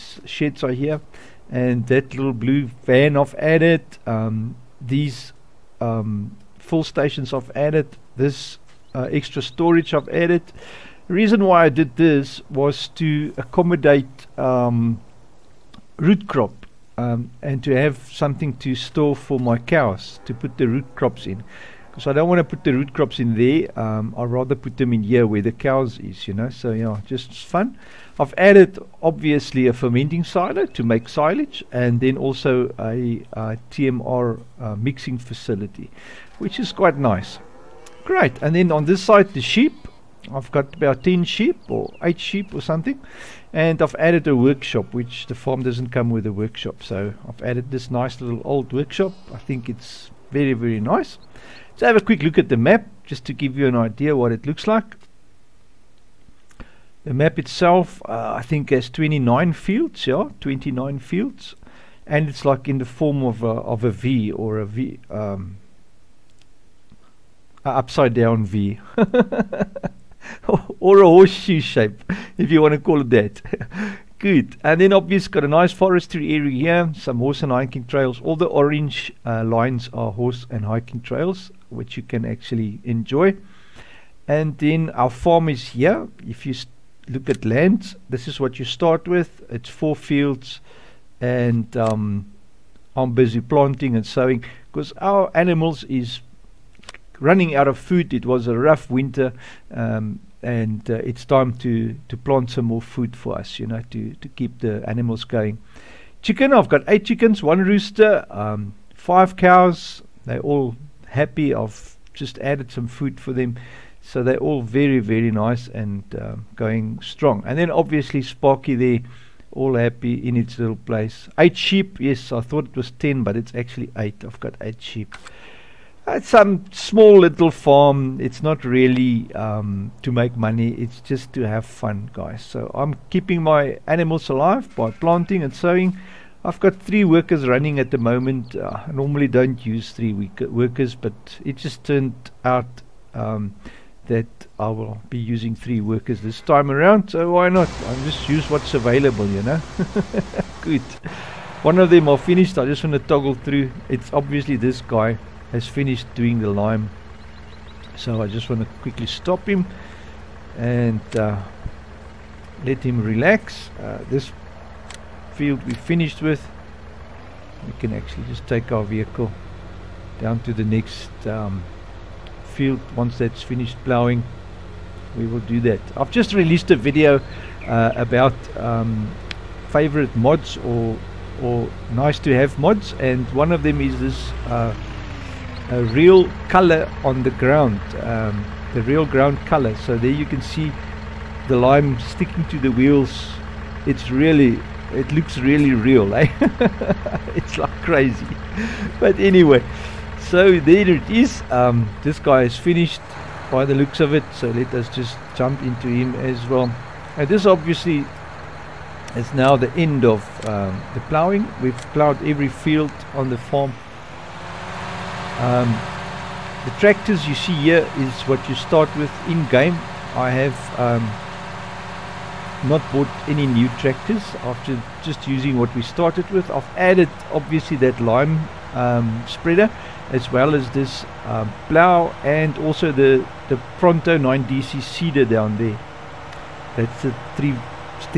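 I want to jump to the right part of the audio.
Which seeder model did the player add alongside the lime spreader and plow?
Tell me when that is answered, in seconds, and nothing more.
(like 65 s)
233 s.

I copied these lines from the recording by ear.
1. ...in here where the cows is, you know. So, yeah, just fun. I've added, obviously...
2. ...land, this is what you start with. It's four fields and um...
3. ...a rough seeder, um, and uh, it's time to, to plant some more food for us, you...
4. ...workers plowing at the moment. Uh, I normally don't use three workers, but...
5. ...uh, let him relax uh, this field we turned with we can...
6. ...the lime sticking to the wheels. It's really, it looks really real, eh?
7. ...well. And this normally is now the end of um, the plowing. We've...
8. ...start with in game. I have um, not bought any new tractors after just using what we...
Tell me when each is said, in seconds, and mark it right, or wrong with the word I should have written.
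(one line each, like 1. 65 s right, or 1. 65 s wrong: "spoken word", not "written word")
1. 24 s right
2. 87 s right
3. 98 s wrong: "winter", not "seeder"
4. 137 s wrong: "running", not "plowing"
5. 161 s wrong: "finished", not "turned"
6. 191 s right
7. 206 s wrong: "obviously", not "normally"
8. 218 s right.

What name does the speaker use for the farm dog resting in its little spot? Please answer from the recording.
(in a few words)
Sparky.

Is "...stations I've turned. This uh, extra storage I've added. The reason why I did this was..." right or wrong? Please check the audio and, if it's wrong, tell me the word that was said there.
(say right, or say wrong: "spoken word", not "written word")
wrong: "added", not "turned".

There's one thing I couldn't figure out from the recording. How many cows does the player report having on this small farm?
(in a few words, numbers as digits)
5.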